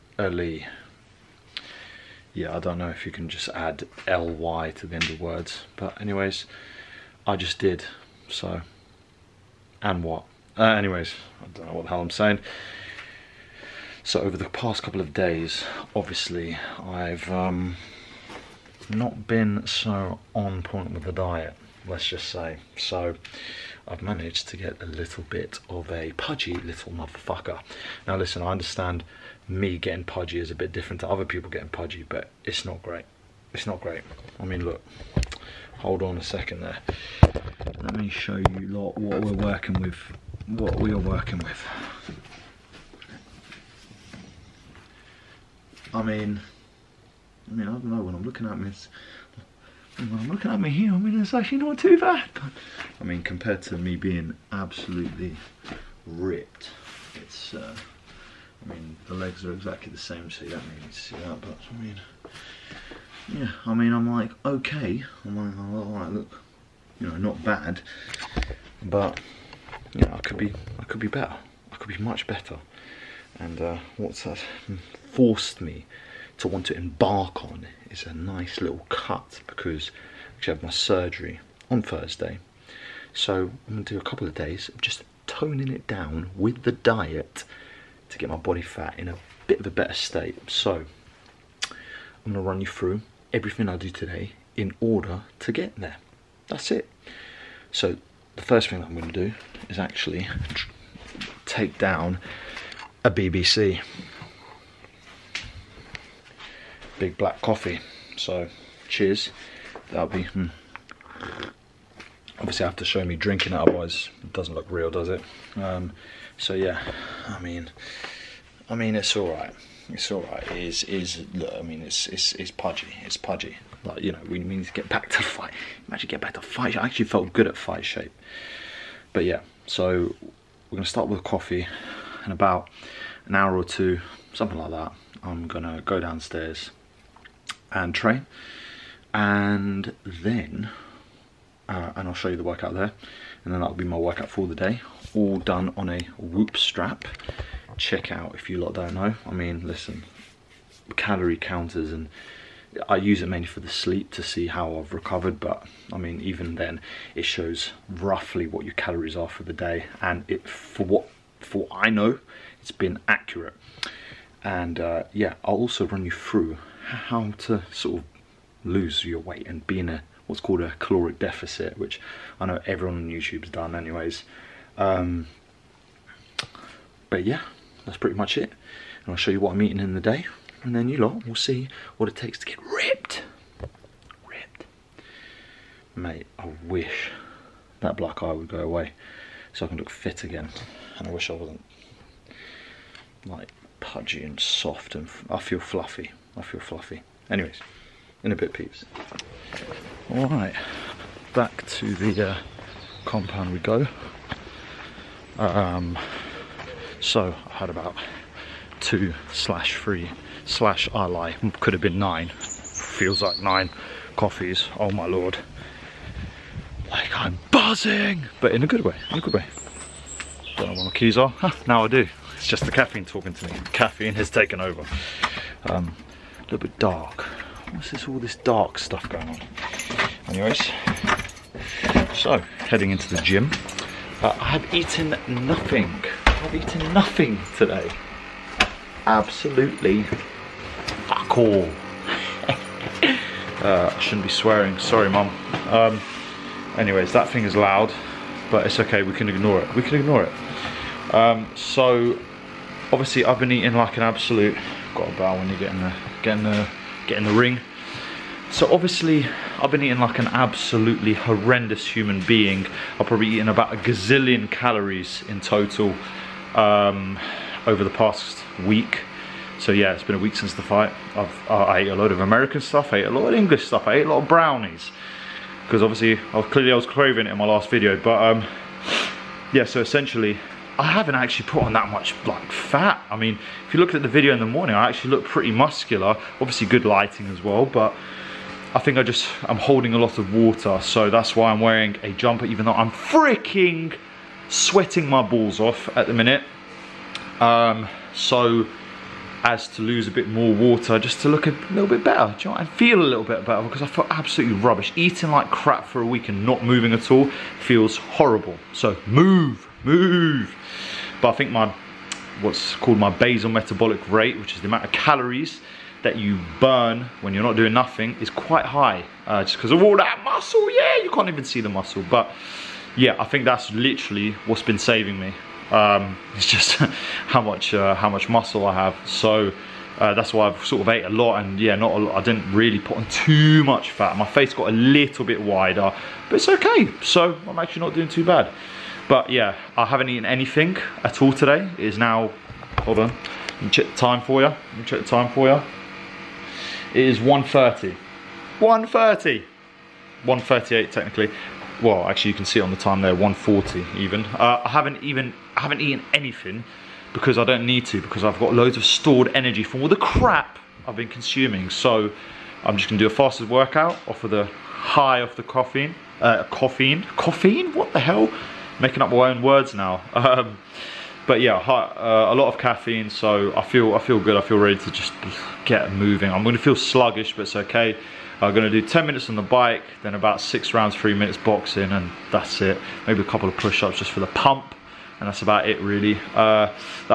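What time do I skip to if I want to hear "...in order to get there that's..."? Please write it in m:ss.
1:34.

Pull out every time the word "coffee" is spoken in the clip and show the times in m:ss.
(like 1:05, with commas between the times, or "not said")
1:47, 2:11, 3:34.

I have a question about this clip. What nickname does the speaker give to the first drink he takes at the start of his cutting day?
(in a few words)
BBC.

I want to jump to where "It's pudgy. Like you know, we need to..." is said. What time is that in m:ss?
2:03.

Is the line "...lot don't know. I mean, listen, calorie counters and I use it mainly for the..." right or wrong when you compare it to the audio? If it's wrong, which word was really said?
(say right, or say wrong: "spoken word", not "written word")
right.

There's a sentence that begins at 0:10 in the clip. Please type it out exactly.
Uh, anyways, I don't know what the hell I'm saying.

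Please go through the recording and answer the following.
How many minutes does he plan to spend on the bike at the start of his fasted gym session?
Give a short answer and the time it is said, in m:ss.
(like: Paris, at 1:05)
10, at 6:18.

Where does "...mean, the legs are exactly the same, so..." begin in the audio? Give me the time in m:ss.
0:58.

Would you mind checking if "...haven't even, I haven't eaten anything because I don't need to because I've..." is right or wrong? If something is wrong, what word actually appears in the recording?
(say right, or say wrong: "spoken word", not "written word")
right.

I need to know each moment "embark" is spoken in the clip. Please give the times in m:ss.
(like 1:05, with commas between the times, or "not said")
1:16.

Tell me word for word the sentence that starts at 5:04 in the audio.
Eating like crap for a week and not moving at all feels horrible.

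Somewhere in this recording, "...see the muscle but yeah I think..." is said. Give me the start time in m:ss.
5:21.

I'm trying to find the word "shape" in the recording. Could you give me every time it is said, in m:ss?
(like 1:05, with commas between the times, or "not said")
2:07.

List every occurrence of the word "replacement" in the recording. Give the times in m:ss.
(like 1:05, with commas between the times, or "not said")
not said.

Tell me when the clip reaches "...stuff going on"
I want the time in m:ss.
3:48.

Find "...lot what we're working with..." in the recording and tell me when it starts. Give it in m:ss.
0:38.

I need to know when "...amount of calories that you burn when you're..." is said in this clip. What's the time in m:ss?
5:14.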